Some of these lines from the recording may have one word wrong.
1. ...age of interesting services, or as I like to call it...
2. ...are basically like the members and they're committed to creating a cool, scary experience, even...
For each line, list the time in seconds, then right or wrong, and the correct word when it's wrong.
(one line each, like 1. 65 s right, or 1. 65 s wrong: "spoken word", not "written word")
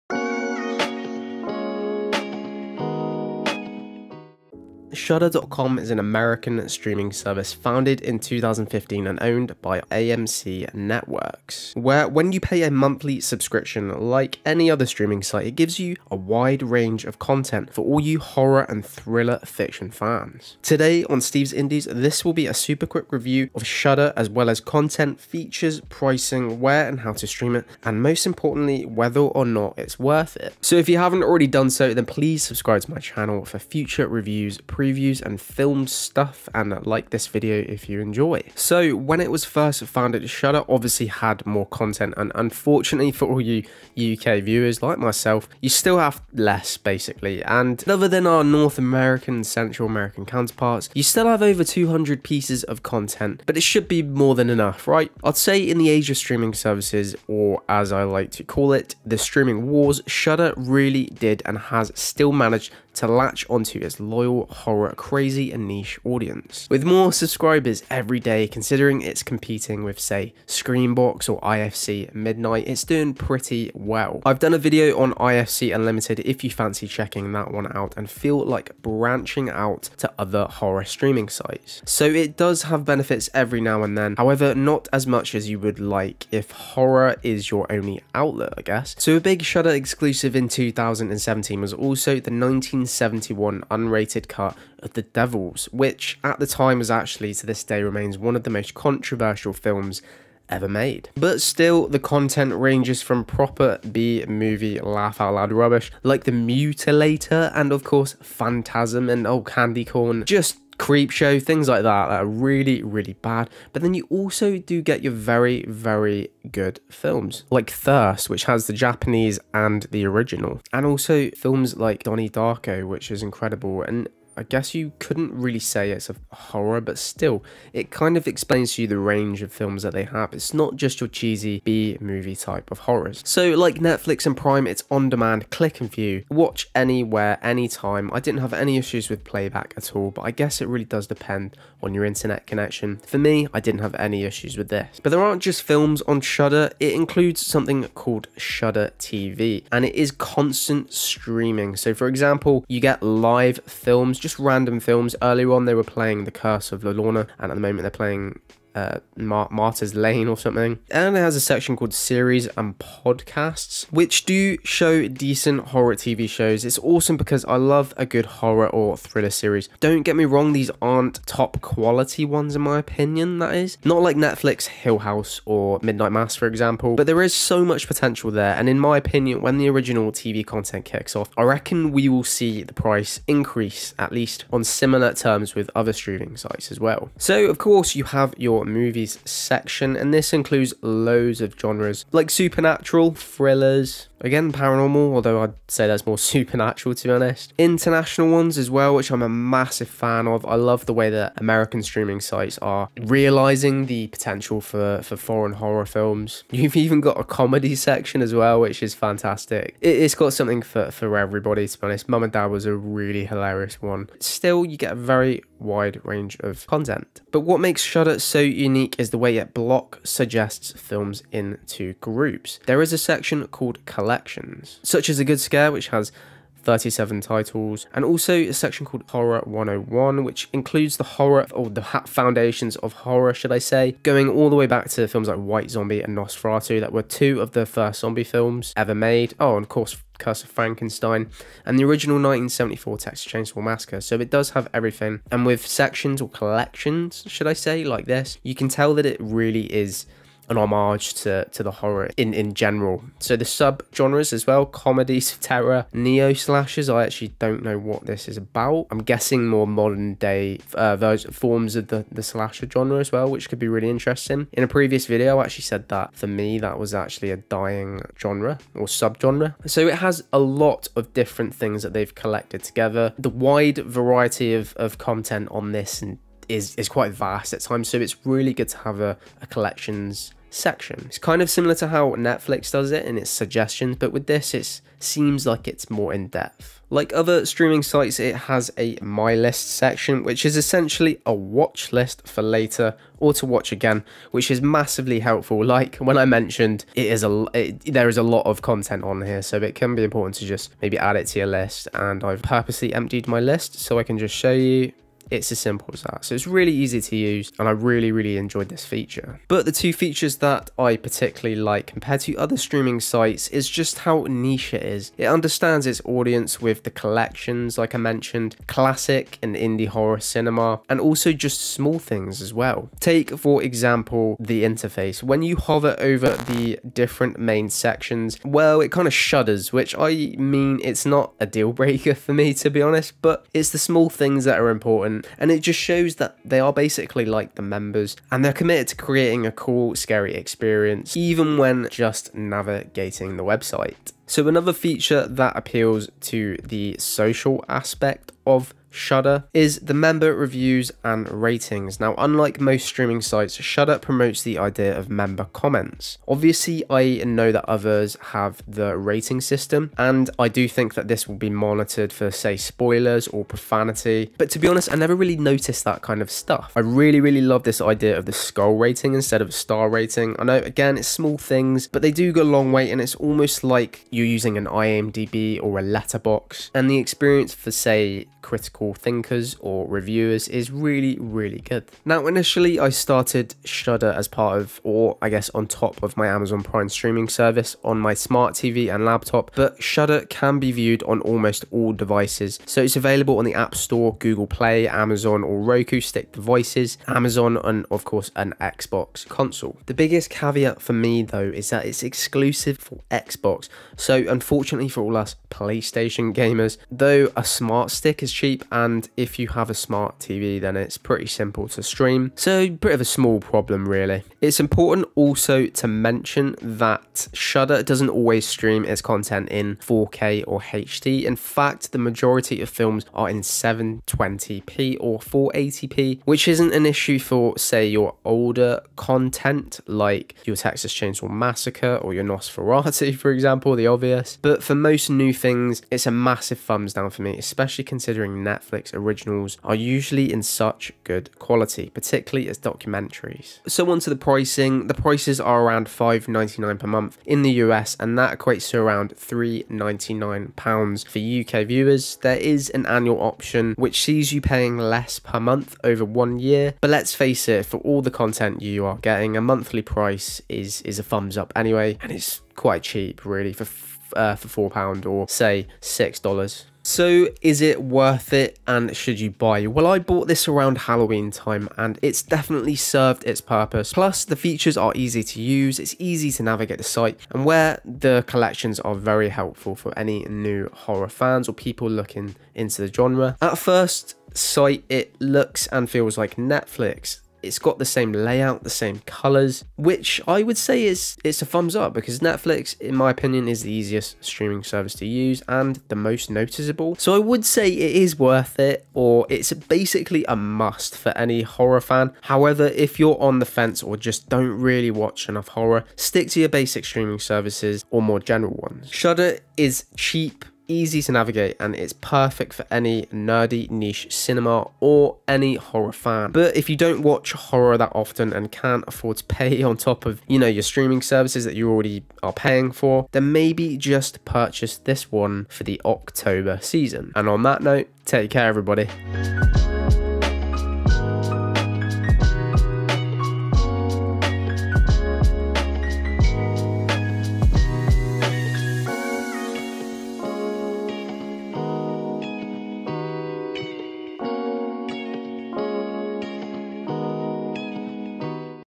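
1. 55 s wrong: "streaming", not "interesting"
2. 336 s right.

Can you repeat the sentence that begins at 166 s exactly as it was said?
It's awesome because I love a good horror or thriller series.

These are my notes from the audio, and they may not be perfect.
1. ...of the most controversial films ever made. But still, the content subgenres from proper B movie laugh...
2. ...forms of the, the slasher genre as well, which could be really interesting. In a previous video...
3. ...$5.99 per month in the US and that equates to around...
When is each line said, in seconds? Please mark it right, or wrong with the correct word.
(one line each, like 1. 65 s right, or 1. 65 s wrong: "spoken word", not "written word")
1. 98 s wrong: "ranges", not "subgenres"
2. 261 s right
3. 445 s right.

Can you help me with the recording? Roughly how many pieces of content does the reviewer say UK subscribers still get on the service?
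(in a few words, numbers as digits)
over 200.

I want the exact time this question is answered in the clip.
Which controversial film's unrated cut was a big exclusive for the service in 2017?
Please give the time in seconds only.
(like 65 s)
94 s.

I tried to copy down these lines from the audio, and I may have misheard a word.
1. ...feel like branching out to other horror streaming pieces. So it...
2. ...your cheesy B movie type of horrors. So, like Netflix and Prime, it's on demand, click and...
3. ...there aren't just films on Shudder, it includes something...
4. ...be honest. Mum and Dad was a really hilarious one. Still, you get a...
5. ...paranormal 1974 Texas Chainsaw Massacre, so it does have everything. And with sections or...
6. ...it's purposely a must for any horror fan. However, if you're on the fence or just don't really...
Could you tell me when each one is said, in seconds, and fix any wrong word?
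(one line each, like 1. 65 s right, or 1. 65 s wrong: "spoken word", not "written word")
1. 78 s wrong: "sites", not "pieces"
2. 130 s right
3. 145 s right
4. 211 s right
5. 241 s wrong: "original", not "paranormal"
6. 499 s wrong: "basically", not "purposely".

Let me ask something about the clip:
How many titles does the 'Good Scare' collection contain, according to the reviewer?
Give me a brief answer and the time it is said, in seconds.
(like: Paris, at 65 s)
37, at 226 s.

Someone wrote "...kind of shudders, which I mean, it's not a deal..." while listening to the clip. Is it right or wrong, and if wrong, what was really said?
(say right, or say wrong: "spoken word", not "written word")
right.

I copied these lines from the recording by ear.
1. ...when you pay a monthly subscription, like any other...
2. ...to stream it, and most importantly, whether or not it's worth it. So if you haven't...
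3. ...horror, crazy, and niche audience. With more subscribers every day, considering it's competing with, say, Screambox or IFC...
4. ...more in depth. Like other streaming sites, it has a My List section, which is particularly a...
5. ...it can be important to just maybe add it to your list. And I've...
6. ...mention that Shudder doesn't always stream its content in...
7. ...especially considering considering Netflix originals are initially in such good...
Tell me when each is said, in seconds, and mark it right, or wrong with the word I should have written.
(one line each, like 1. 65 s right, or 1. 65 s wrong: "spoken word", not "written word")
1. 12 s right
2. 27 s right
3. 64 s right
4. 285 s wrong: "essentially", not "particularly"
5. 299 s right
6. 415 s right
7. 437 s wrong: "usually", not "initially".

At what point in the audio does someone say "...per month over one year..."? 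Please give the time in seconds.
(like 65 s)
455 s.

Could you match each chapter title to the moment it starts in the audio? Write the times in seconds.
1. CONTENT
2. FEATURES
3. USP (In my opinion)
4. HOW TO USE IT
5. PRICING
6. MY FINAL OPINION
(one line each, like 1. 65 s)
1. 40 s
2. 146 s
3. 318 s
4. 389 s
5. 443 s
6. 467 s.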